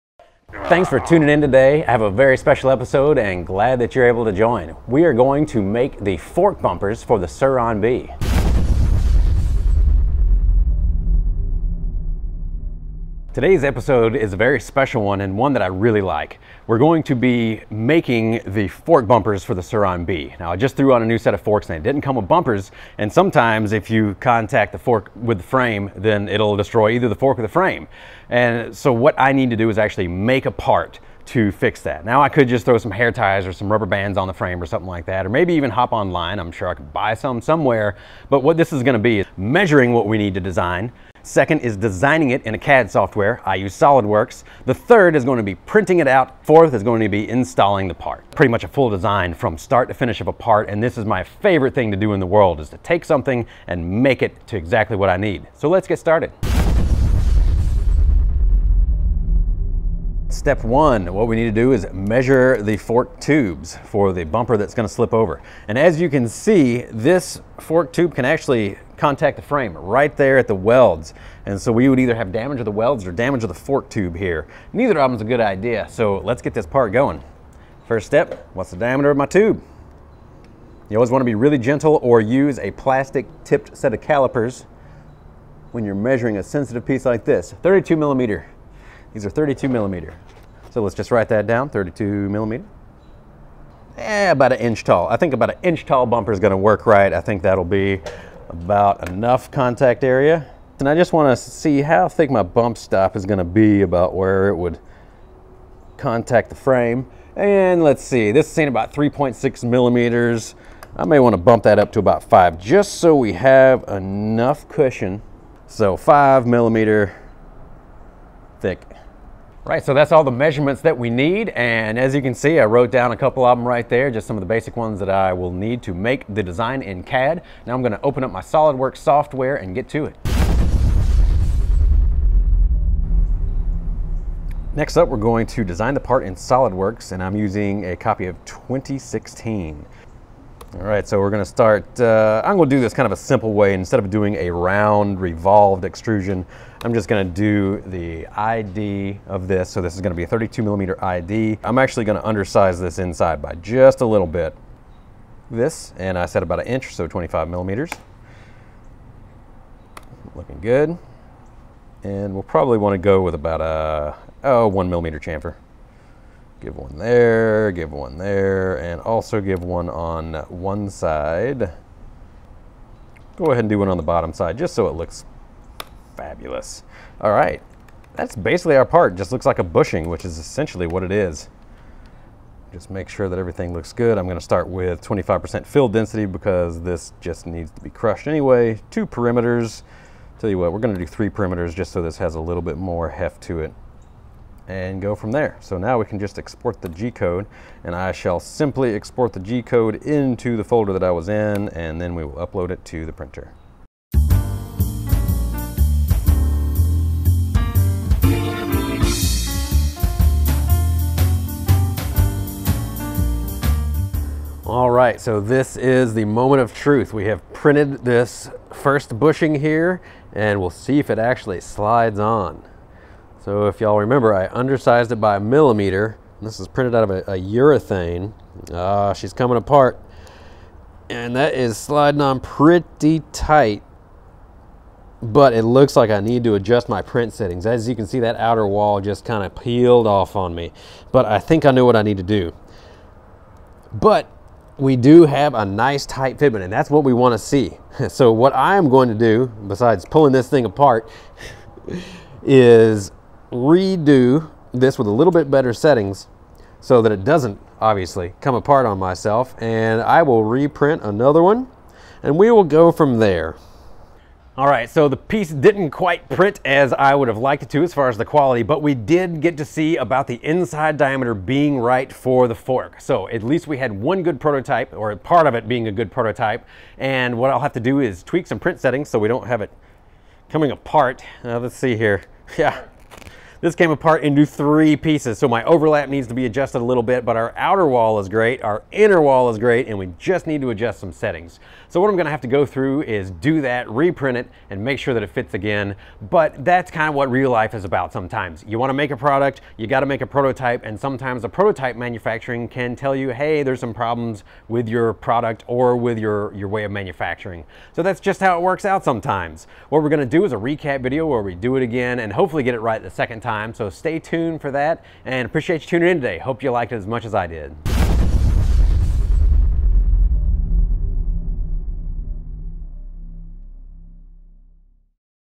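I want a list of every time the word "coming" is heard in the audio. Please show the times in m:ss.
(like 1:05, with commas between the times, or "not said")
3:49, 4:40.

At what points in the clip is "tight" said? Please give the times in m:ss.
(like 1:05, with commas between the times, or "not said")
3:53, 4:06.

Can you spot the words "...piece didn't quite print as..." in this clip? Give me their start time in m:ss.
4:25.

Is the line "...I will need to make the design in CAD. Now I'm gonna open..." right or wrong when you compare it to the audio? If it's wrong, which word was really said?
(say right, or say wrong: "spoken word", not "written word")
right.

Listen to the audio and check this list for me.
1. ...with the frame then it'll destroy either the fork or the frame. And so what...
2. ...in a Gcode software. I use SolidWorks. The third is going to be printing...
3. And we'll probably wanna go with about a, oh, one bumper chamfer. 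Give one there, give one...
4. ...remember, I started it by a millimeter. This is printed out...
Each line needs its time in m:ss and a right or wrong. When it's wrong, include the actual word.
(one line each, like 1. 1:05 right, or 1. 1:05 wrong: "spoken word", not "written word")
1. 0:25 right
2. 0:42 wrong: "CAD", not "Gcode"
3. 2:42 wrong: "millimeter", not "bumper"
4. 3:43 wrong: "undersized", not "started".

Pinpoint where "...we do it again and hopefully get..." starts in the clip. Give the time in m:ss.
5:11.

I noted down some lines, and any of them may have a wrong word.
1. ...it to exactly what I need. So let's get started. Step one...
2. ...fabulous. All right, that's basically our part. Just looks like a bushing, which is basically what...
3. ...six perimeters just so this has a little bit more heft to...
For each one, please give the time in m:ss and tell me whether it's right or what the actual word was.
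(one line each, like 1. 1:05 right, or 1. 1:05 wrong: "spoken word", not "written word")
1. 0:54 right
2. 2:56 wrong: "essentially", not "basically"
3. 3:11 wrong: "three", not "six".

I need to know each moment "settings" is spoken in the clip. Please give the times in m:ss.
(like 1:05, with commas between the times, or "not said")
3:57, 4:15, 4:38, 4:51.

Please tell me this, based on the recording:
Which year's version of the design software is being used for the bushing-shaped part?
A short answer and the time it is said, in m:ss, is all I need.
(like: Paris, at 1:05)
2016, at 2:18.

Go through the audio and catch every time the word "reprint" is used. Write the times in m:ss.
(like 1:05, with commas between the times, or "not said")
4:20, 4:53.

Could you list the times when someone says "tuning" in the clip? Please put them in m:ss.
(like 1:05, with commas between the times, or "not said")
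0:00, 5:15.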